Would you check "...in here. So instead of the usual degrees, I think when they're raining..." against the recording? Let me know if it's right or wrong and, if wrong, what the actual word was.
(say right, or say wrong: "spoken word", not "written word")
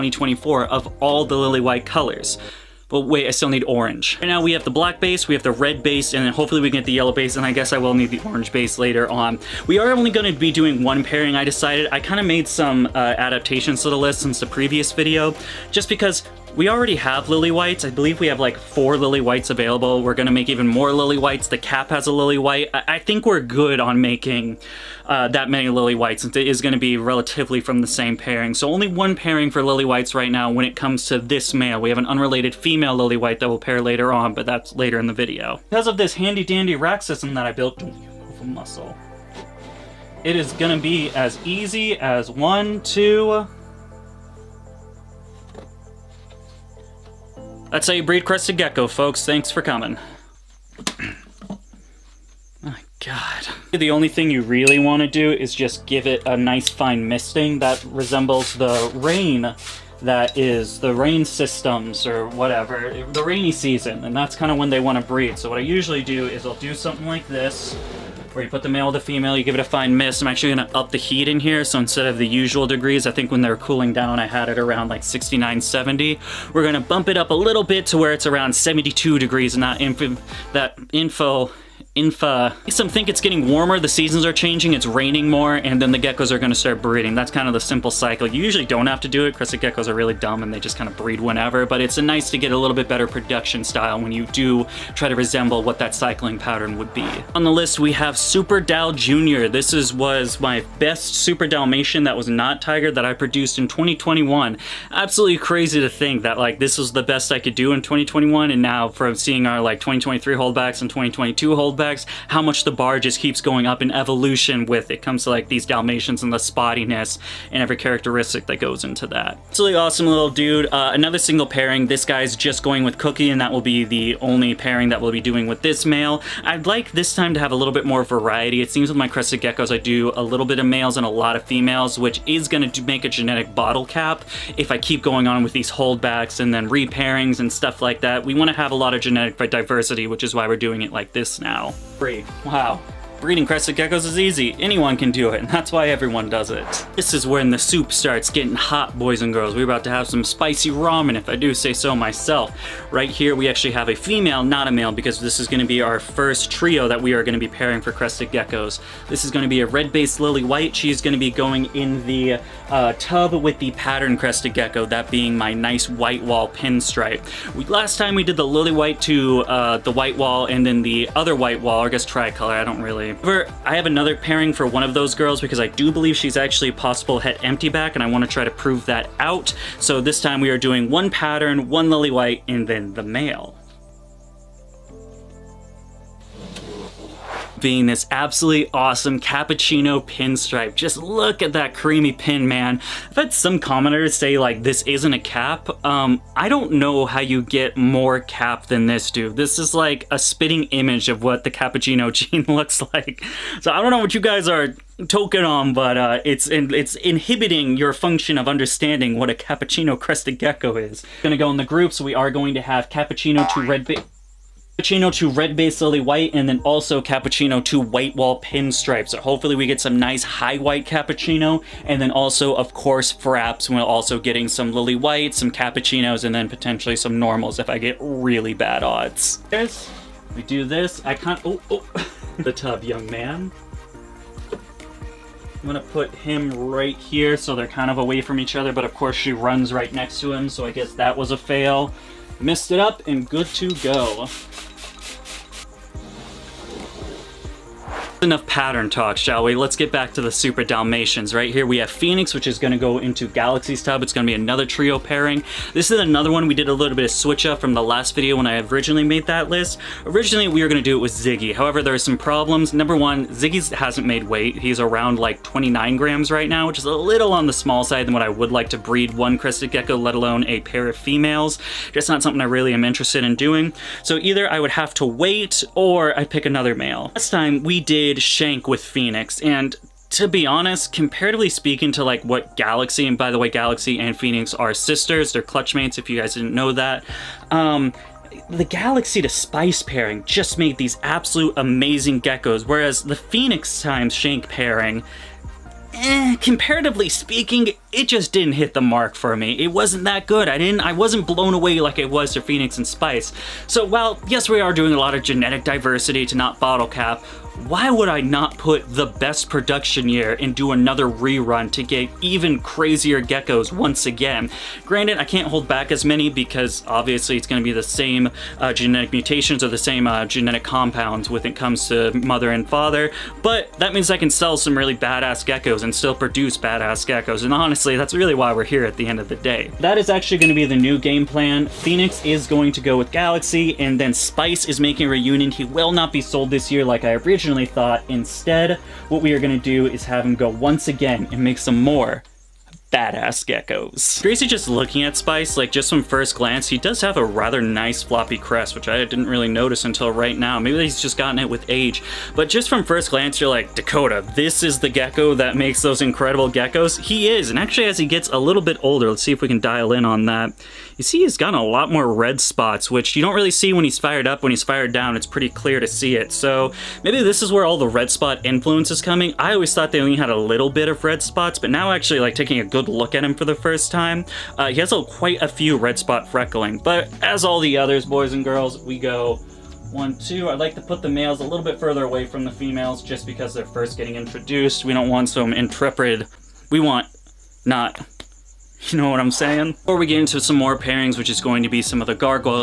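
wrong: "cooling", not "raining".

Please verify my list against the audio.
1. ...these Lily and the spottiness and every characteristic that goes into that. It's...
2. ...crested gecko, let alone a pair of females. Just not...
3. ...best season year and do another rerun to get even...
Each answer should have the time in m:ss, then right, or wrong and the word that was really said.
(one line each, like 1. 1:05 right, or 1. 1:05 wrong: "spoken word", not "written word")
1. 1:55 wrong: "Dalmatians", not "Lily"
2. 4:29 right
3. 5:09 wrong: "production", not "season".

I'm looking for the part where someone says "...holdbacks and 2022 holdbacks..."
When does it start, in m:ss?
1:50.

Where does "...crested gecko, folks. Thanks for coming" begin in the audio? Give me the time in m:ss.
0:48.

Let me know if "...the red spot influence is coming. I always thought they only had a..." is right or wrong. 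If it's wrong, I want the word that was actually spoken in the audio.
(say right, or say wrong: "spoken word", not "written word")
right.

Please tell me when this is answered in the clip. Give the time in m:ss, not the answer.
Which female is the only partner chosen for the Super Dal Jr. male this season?
2:02.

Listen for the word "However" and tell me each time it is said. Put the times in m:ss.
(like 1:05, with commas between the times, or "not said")
2:53, 4:21.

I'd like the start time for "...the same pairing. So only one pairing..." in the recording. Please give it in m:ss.
0:27.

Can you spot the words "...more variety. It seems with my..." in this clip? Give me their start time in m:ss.
2:07.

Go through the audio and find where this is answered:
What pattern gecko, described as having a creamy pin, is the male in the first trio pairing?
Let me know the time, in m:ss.
3:09.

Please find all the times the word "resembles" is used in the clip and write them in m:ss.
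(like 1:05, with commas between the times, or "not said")
0:57, 1:35.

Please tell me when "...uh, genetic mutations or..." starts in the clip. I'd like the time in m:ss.
5:18.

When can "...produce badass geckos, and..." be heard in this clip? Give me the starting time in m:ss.
5:26.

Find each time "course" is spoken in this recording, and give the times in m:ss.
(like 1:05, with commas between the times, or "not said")
3:42, 3:58.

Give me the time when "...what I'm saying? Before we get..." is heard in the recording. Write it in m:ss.
6:29.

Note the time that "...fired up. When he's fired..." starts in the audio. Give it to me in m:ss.
6:03.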